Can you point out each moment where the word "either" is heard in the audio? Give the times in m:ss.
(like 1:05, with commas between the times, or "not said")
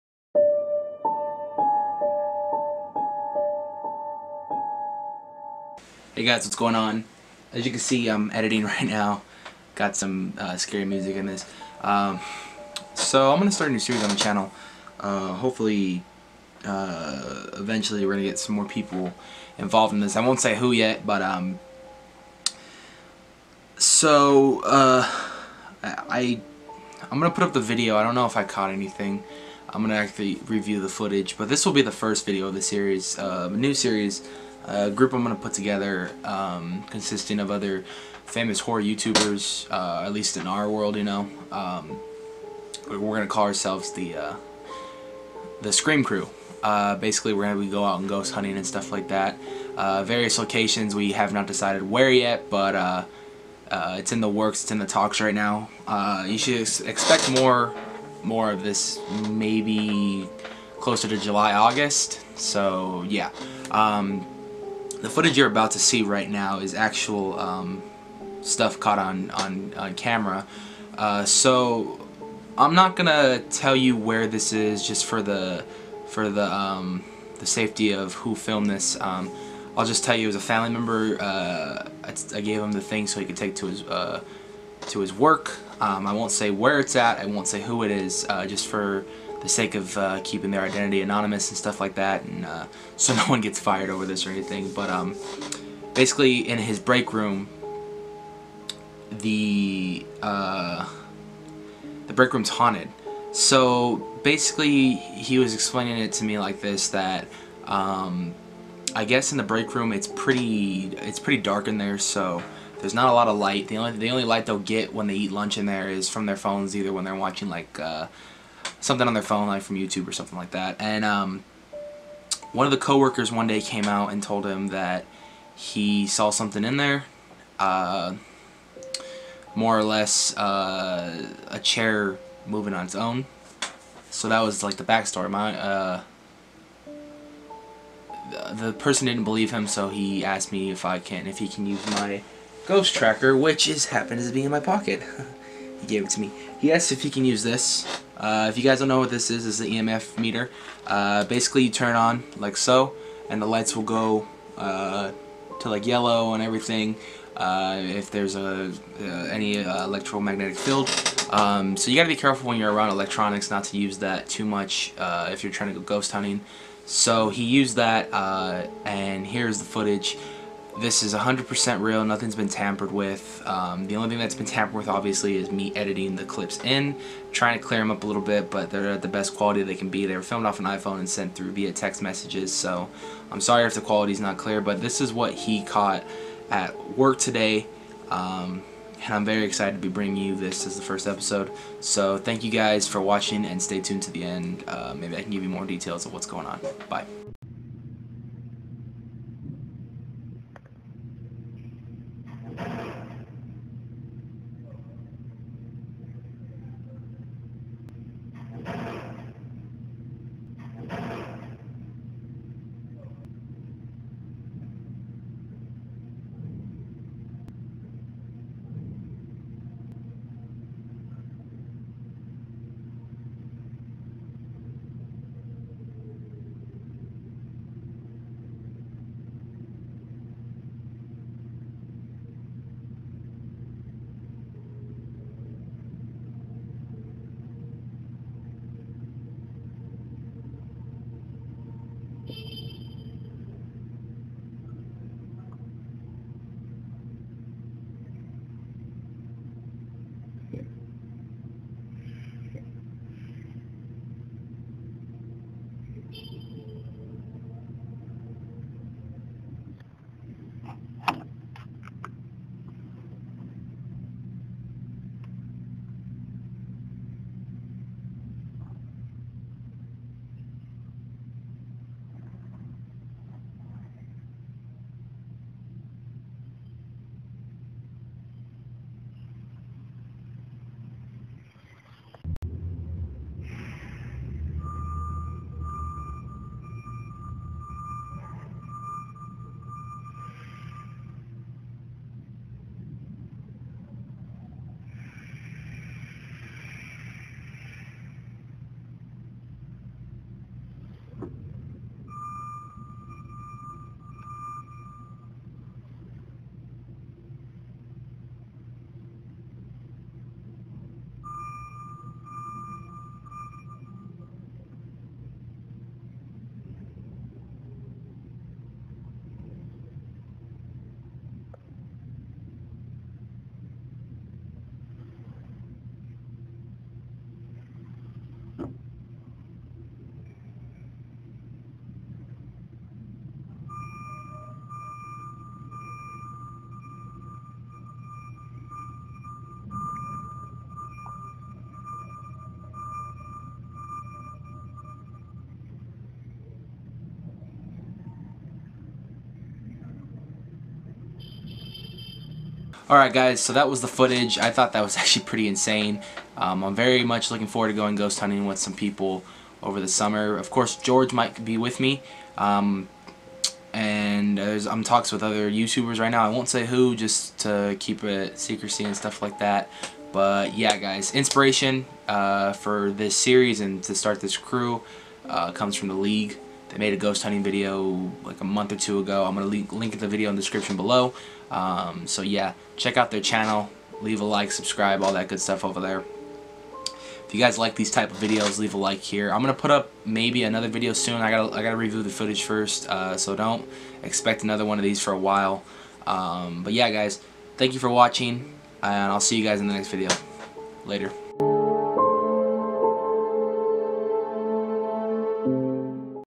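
1:56.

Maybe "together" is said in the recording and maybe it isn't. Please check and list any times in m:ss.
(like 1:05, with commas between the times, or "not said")
0:35.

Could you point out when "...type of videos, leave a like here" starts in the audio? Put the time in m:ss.
6:27.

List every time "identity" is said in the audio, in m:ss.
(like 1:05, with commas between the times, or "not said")
1:30.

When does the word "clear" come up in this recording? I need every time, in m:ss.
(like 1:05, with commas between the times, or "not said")
2:57, 3:04.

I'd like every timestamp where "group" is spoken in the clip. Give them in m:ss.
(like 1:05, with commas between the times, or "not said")
0:34.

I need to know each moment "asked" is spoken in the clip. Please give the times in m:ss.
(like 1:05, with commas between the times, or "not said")
2:20, 2:26.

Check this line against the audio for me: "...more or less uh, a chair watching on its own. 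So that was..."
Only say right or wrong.
wrong.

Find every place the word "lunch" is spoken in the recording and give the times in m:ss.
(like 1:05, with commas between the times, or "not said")
1:55.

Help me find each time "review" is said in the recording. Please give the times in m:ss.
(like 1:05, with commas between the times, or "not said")
0:30, 6:31.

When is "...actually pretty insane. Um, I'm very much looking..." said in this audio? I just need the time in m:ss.
5:54.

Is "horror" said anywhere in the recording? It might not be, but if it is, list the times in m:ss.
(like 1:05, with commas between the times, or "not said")
0:38.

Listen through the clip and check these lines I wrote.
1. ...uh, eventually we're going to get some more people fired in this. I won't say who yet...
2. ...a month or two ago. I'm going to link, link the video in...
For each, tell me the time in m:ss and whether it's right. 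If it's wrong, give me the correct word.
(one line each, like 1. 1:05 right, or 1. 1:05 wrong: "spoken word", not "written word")
1. 0:16 wrong: "involved", not "fired"
2. 6:18 right.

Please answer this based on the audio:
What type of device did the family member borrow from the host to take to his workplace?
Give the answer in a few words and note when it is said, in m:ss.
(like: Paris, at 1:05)
EMF meter, at 2:29.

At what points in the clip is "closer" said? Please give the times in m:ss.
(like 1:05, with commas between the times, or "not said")
1:00.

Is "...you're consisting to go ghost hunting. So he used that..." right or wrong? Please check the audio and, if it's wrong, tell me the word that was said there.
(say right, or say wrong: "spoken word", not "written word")
wrong: "trying", not "consisting".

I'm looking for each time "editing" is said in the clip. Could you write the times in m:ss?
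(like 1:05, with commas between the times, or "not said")
0:08, 2:55.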